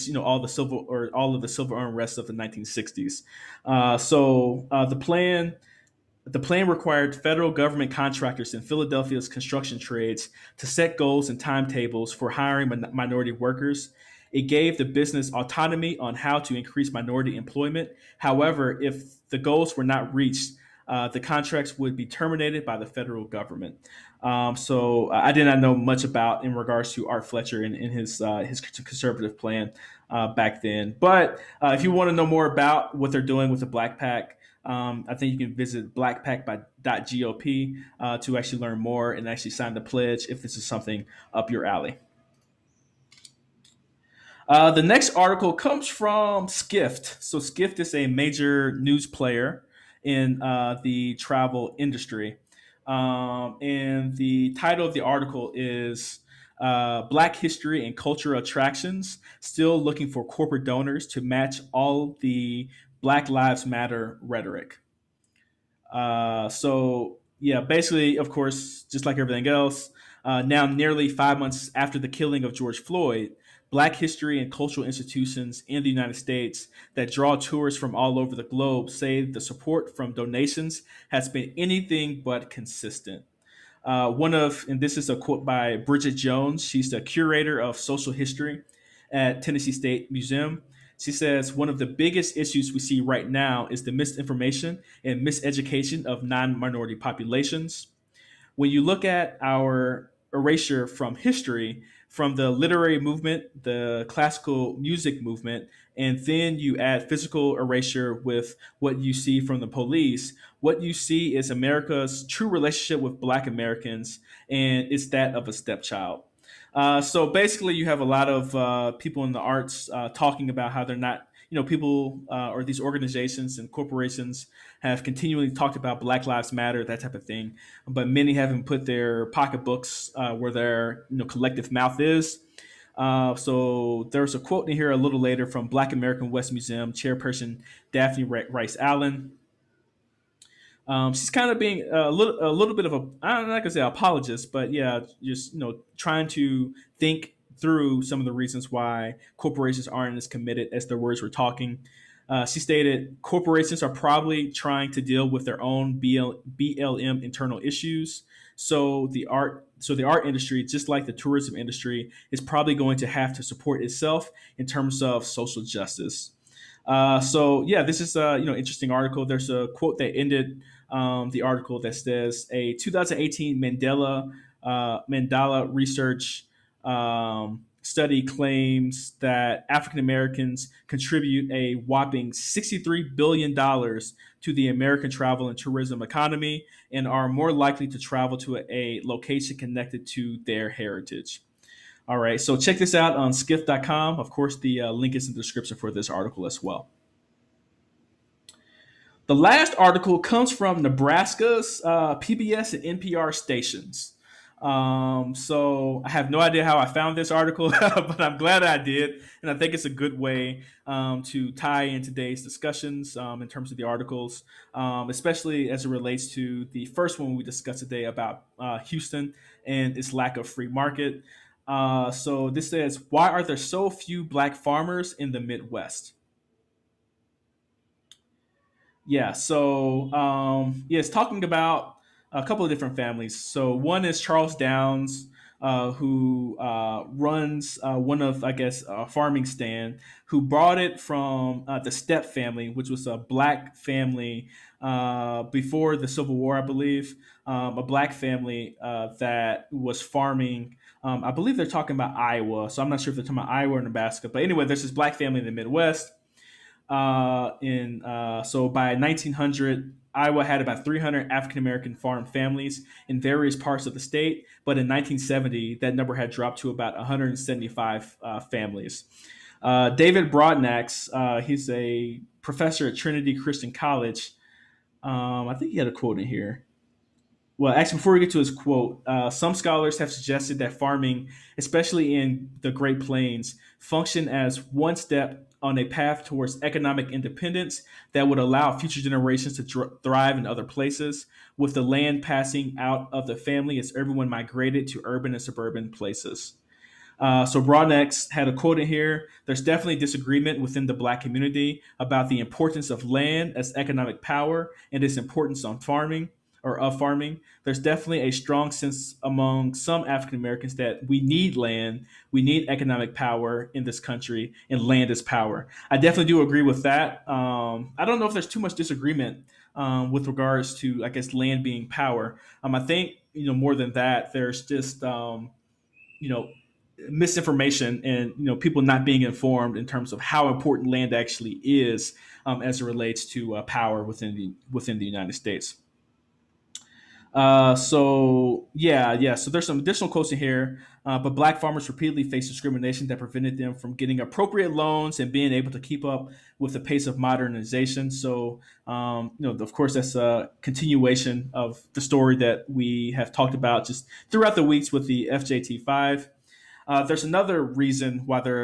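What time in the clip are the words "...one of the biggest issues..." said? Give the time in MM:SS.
01:31.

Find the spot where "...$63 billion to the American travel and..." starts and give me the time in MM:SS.
03:02.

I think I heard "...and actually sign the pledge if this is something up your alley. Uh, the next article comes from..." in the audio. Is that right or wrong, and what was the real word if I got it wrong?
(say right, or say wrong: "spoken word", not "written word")
right.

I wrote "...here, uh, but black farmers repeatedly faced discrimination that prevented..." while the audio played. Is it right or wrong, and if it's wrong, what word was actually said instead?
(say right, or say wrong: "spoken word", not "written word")
right.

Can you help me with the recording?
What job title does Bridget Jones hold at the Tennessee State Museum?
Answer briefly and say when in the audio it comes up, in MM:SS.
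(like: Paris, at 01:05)
Curator of social history, at 01:27.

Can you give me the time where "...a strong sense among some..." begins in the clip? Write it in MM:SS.
05:08.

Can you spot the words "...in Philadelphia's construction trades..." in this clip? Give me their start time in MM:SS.
00:08.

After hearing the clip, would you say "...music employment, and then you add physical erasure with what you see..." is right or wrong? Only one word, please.
wrong.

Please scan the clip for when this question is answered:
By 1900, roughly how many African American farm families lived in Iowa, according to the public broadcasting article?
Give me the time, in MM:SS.
04:20.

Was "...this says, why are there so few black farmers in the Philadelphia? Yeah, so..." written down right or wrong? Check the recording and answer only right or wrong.
wrong.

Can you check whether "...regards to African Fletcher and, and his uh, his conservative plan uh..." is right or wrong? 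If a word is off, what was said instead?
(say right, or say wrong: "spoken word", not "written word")
wrong: "Art", not "African".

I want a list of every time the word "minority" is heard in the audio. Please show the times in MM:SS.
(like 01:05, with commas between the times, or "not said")
00:12, 00:16, 01:36.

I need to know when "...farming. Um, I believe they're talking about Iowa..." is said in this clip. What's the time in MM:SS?
04:10.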